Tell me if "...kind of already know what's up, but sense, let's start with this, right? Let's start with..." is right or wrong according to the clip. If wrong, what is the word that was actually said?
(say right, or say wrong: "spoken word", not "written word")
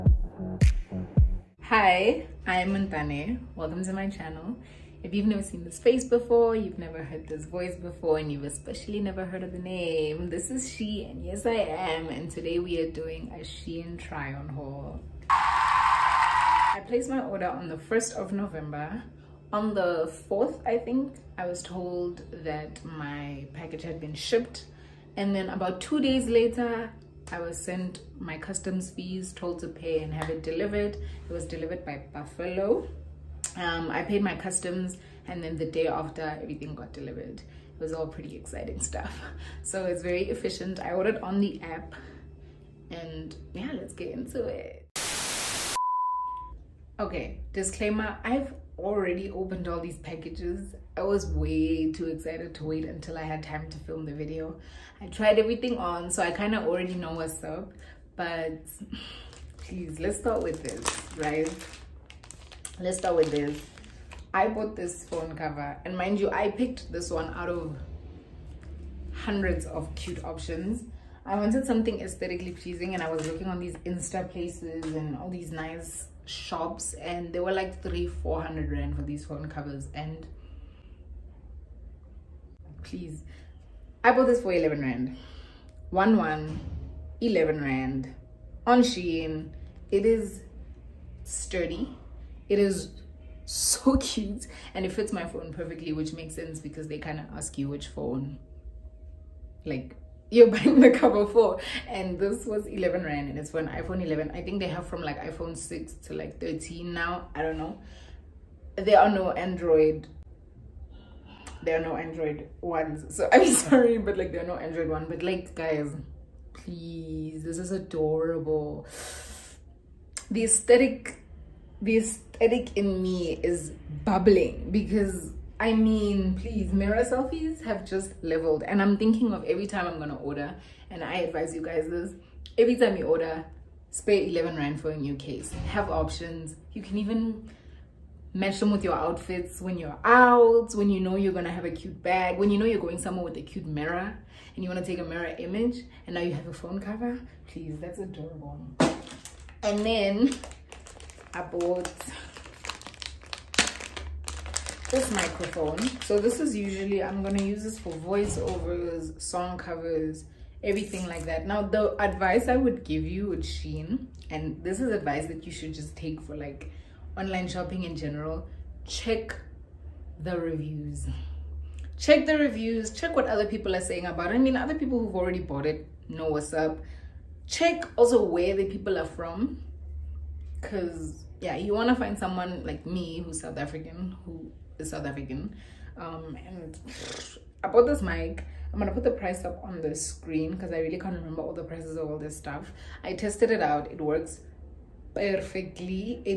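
wrong: "please", not "sense".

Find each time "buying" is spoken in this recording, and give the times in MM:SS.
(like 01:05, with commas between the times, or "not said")
01:40.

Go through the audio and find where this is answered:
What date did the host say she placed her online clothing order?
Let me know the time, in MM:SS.
00:17.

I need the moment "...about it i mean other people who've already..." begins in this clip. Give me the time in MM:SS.
02:54.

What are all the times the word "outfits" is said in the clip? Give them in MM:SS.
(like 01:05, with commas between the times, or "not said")
02:18.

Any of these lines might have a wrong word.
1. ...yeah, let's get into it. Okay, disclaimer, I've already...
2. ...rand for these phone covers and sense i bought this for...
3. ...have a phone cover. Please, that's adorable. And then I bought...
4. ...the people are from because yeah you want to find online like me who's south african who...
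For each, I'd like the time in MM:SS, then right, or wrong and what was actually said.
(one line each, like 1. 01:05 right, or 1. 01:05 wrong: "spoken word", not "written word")
1. 00:43 right
2. 01:18 wrong: "please", not "sense"
3. 02:26 right
4. 02:58 wrong: "someone", not "online".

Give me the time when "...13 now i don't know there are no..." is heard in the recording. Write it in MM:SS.
01:46.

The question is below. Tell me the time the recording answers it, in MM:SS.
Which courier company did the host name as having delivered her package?
00:32.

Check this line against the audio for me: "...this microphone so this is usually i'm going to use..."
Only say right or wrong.
right.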